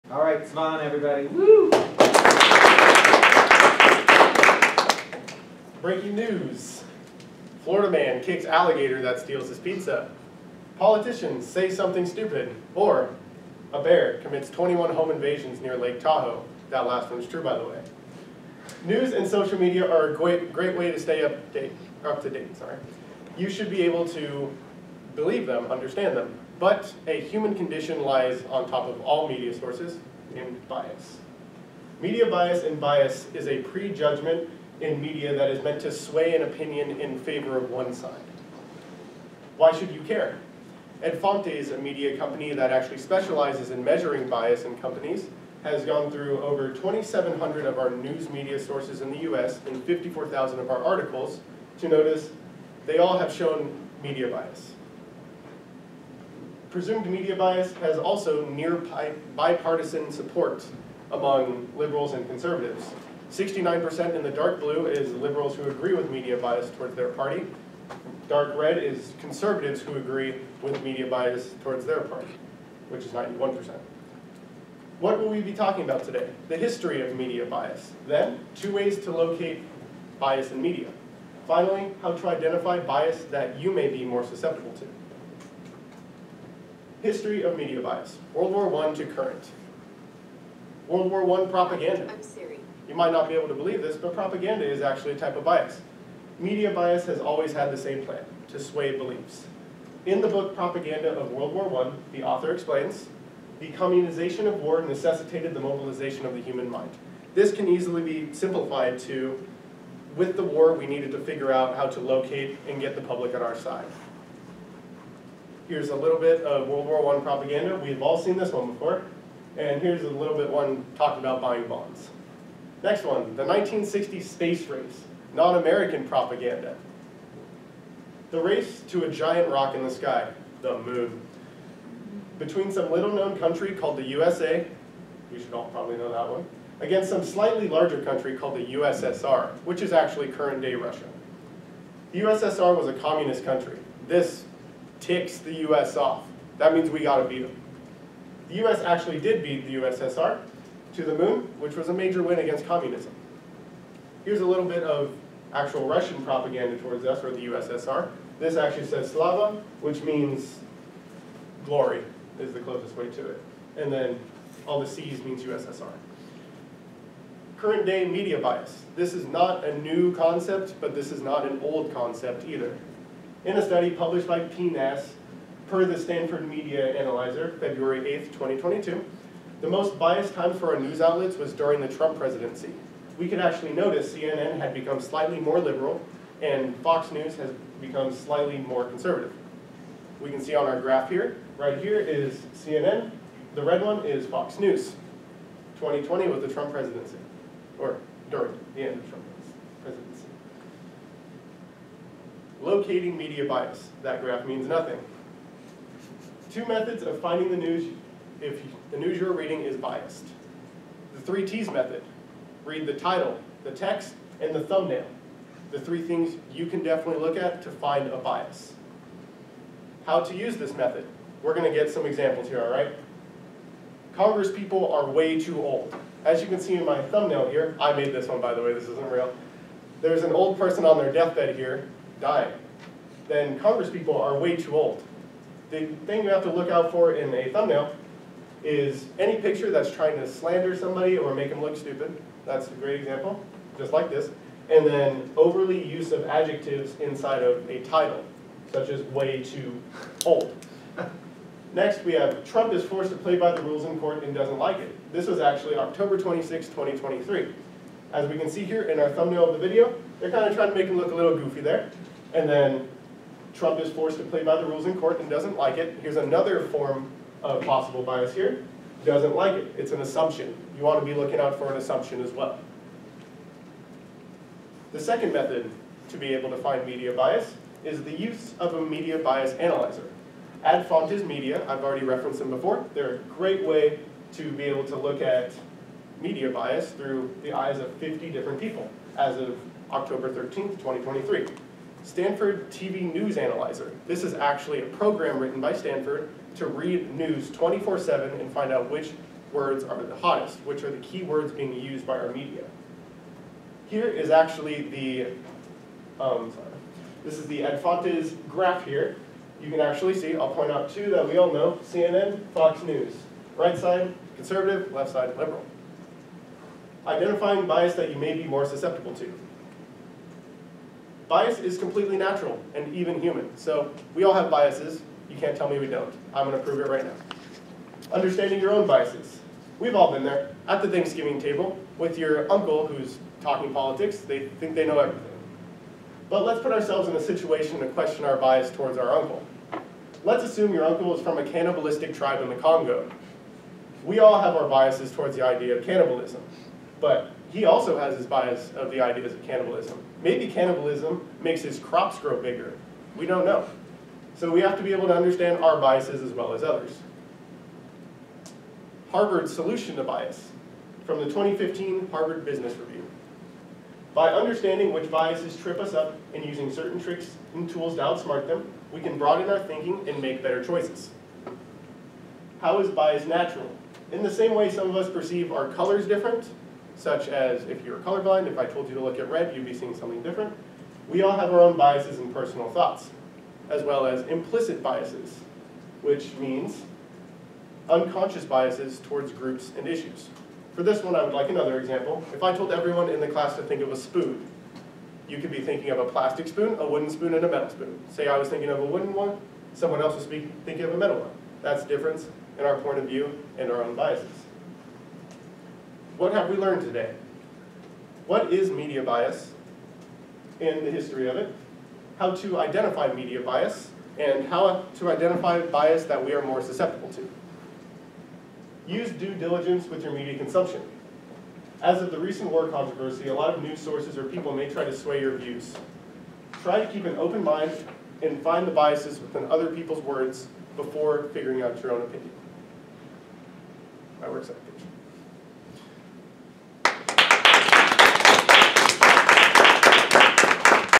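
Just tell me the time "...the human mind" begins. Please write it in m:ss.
1:46.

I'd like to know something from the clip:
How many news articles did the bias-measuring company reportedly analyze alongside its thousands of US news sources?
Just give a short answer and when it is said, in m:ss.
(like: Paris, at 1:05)
54,000, at 0:49.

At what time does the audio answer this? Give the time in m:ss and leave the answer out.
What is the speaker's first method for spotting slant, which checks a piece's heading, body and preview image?
3:31.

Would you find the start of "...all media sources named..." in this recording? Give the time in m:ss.
0:29.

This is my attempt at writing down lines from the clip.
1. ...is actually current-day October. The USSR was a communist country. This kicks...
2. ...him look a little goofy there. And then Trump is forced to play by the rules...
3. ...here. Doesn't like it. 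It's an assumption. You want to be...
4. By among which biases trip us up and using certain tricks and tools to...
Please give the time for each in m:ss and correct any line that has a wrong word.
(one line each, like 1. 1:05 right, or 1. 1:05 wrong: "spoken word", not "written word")
1. 2:19 wrong: "Russia", not "October"
2. 4:20 right
3. 4:28 right
4. 6:04 wrong: "understanding", not "among".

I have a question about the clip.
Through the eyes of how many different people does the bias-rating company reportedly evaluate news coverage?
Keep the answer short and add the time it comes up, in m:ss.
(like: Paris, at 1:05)
50, at 4:47.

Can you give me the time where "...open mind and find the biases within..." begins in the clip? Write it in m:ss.
7:07.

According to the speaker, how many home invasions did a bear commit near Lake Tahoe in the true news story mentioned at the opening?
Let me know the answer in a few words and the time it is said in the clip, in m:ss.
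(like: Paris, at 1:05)
21, at 0:14.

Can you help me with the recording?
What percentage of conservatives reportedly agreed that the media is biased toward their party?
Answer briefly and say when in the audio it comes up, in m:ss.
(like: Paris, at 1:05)
91%, at 1:13.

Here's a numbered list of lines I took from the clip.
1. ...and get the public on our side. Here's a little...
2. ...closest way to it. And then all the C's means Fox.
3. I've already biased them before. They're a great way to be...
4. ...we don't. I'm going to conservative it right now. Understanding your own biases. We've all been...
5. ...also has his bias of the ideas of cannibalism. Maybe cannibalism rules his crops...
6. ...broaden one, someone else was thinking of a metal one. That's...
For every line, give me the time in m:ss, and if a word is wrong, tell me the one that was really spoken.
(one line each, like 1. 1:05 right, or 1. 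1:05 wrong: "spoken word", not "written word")
1. 1:52 right
2. 2:42 wrong: "USSR", not "Fox"
3. 4:41 wrong: "referenced", not "biased"
4. 5:25 wrong: "prove", not "conservative"
5. 5:47 wrong: "makes", not "rules"
6. 6:38 wrong: "wooden", not "broaden".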